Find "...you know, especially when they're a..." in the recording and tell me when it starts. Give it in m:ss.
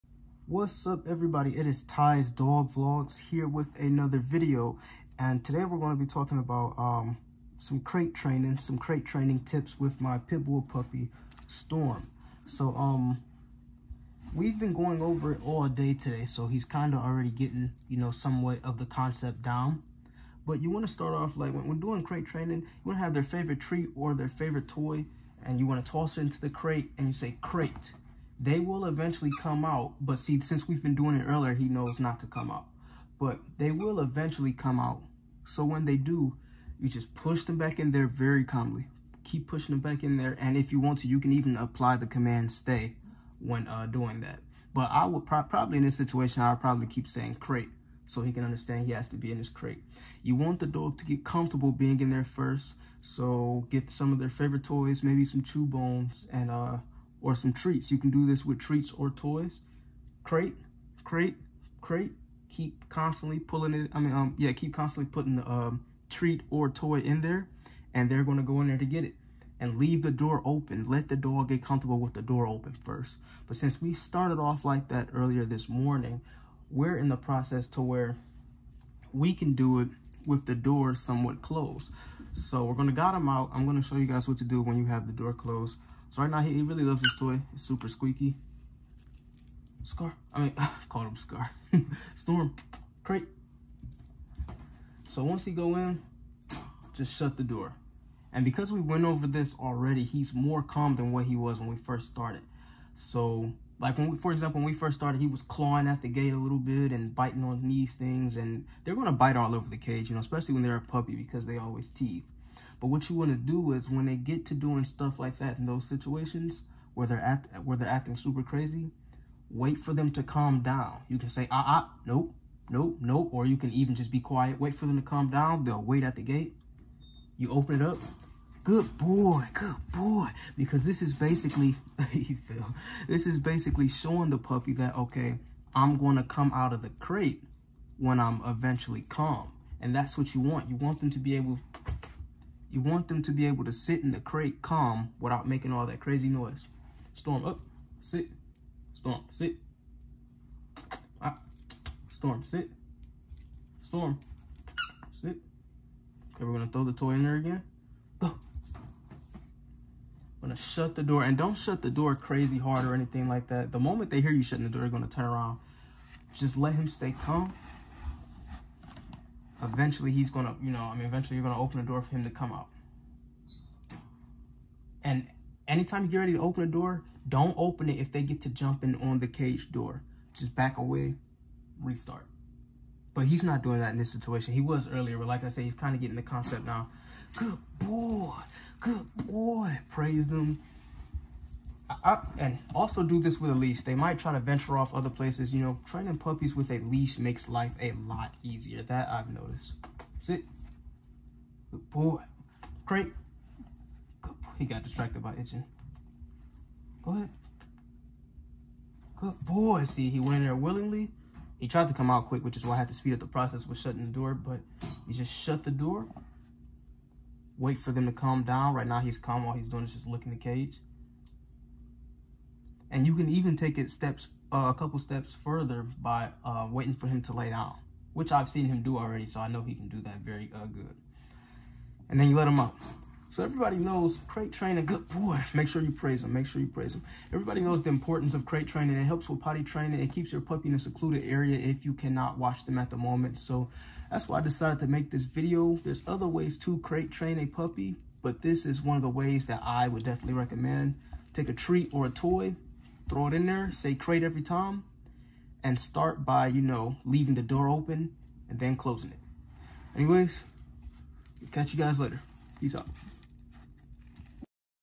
1:50.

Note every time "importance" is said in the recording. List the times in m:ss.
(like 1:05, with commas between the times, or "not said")
3:57.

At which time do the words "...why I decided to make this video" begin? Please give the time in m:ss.
4:04.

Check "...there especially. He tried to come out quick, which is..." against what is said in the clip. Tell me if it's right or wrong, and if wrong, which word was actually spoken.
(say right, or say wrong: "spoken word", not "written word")
wrong: "willingly", not "especially".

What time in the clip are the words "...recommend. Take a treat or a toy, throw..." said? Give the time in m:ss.
4:10.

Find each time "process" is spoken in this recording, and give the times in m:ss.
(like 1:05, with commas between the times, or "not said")
1:17, 3:33.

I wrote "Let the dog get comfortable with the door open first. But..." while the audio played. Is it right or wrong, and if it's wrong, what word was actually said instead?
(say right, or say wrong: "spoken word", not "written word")
right.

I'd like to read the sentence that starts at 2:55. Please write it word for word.
And anytime you get ready to open the door, don't open it if they get to jumping on the cage door.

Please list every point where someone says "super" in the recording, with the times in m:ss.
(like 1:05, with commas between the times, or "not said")
1:27, 1:58.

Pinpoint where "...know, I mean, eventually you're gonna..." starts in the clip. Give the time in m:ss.
2:50.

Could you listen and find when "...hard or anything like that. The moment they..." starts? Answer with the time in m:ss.
2:42.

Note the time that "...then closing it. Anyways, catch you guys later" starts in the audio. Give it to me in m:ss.
4:18.